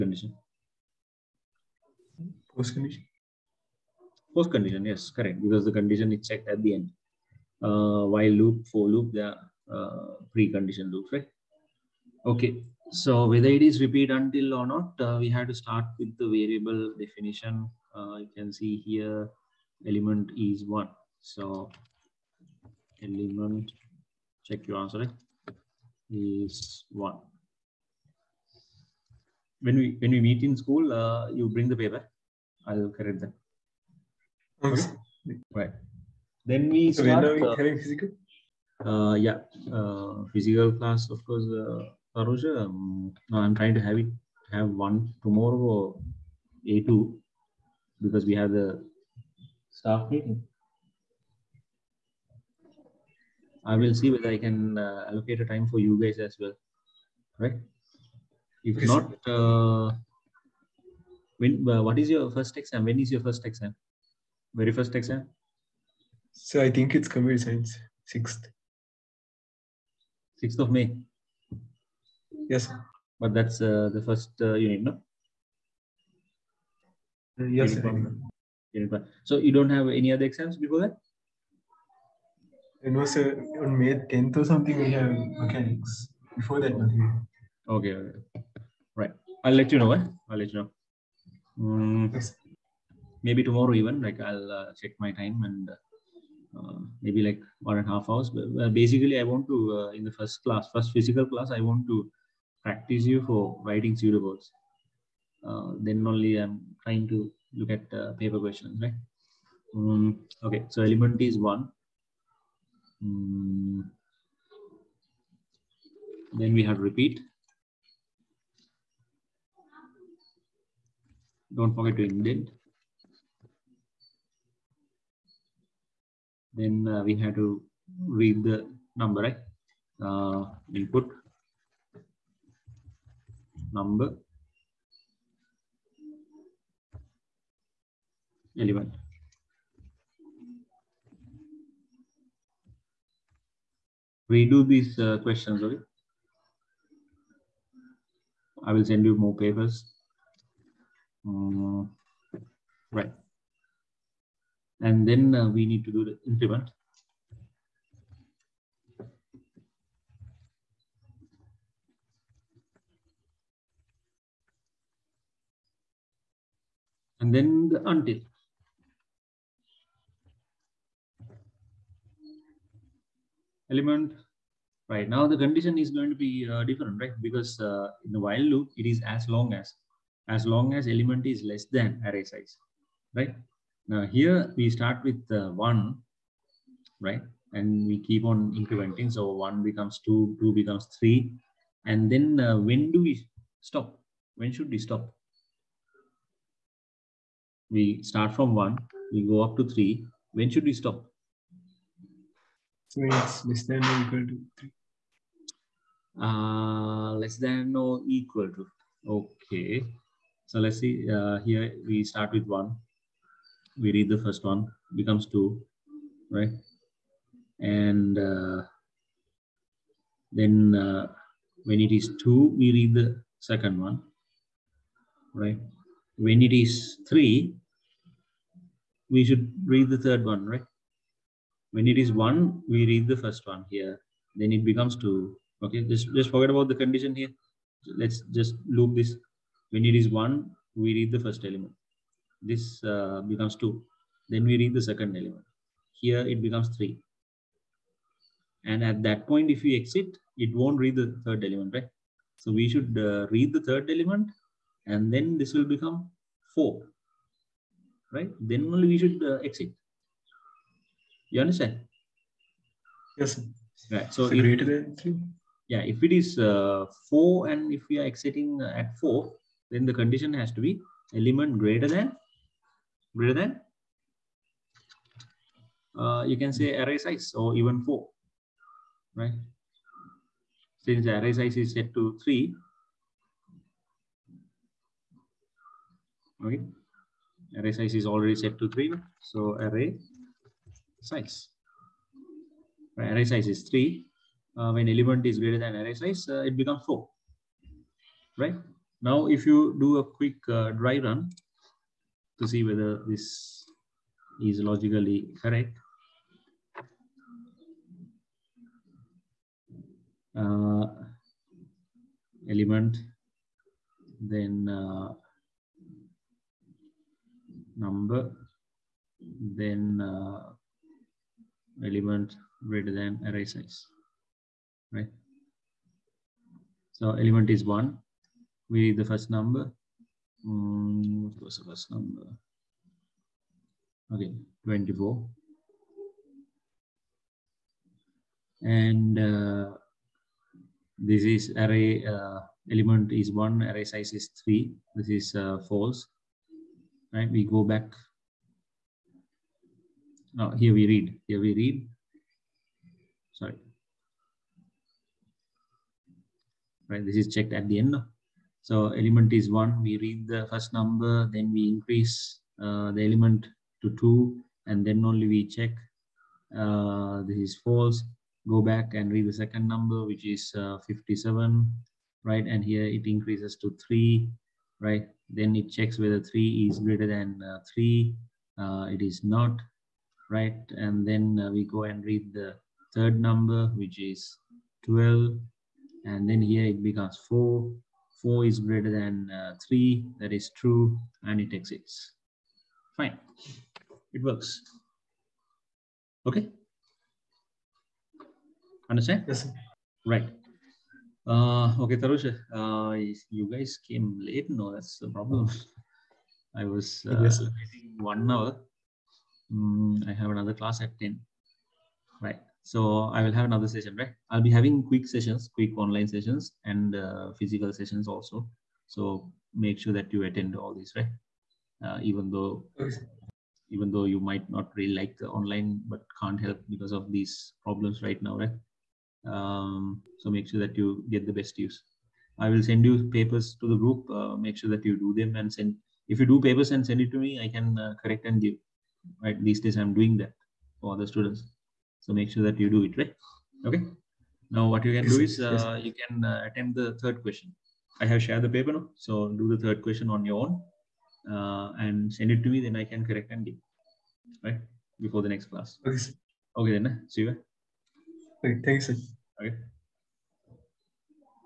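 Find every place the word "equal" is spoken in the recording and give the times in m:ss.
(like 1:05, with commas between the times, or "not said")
3:24, 3:28.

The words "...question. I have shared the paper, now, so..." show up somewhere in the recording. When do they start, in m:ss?
7:27.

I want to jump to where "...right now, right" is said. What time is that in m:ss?
7:08.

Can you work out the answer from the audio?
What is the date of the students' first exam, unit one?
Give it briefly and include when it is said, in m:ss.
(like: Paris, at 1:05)
6 May, at 1:10.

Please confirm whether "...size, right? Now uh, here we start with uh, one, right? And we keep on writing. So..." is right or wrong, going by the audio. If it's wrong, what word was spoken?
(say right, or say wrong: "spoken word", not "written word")
wrong: "incrementing", not "writing".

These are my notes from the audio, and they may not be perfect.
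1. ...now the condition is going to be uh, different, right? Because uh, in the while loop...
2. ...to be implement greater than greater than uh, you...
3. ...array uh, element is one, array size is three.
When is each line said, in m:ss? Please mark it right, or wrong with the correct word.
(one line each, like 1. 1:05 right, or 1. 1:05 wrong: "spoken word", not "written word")
1. 2:55 right
2. 4:30 wrong: "element", not "implement"
3. 5:41 right.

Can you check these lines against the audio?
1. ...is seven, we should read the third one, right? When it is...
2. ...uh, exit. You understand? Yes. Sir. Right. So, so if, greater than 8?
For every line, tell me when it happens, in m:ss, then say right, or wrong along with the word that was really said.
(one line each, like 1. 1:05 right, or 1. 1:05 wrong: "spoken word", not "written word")
1. 3:46 wrong: "three", not "seven"
2. 4:19 wrong: "3", not "8".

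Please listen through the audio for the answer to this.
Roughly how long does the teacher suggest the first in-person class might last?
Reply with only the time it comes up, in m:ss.
1:37.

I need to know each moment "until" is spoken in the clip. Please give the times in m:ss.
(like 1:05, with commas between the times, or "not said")
0:14, 2:47.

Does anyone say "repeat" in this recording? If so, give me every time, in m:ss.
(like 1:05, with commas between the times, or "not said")
0:13, 1:56.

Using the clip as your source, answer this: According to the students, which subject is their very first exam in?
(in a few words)
Computer science.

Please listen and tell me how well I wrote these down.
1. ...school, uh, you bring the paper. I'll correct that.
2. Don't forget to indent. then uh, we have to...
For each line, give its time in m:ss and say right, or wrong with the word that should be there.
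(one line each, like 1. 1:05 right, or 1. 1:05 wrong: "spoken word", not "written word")
1. 0:30 right
2. 2:01 right.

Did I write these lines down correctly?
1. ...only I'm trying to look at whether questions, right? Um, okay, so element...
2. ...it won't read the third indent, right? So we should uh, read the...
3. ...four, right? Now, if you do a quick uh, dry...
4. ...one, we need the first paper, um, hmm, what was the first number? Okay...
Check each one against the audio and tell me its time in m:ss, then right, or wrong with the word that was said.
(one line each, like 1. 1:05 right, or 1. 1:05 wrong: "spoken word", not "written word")
1. 1:46 wrong: "paper", not "whether"
2. 4:10 wrong: "element", not "indent"
3. 4:56 right
4. 5:27 wrong: "number", not "paper".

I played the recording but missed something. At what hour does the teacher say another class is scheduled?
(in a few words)
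10.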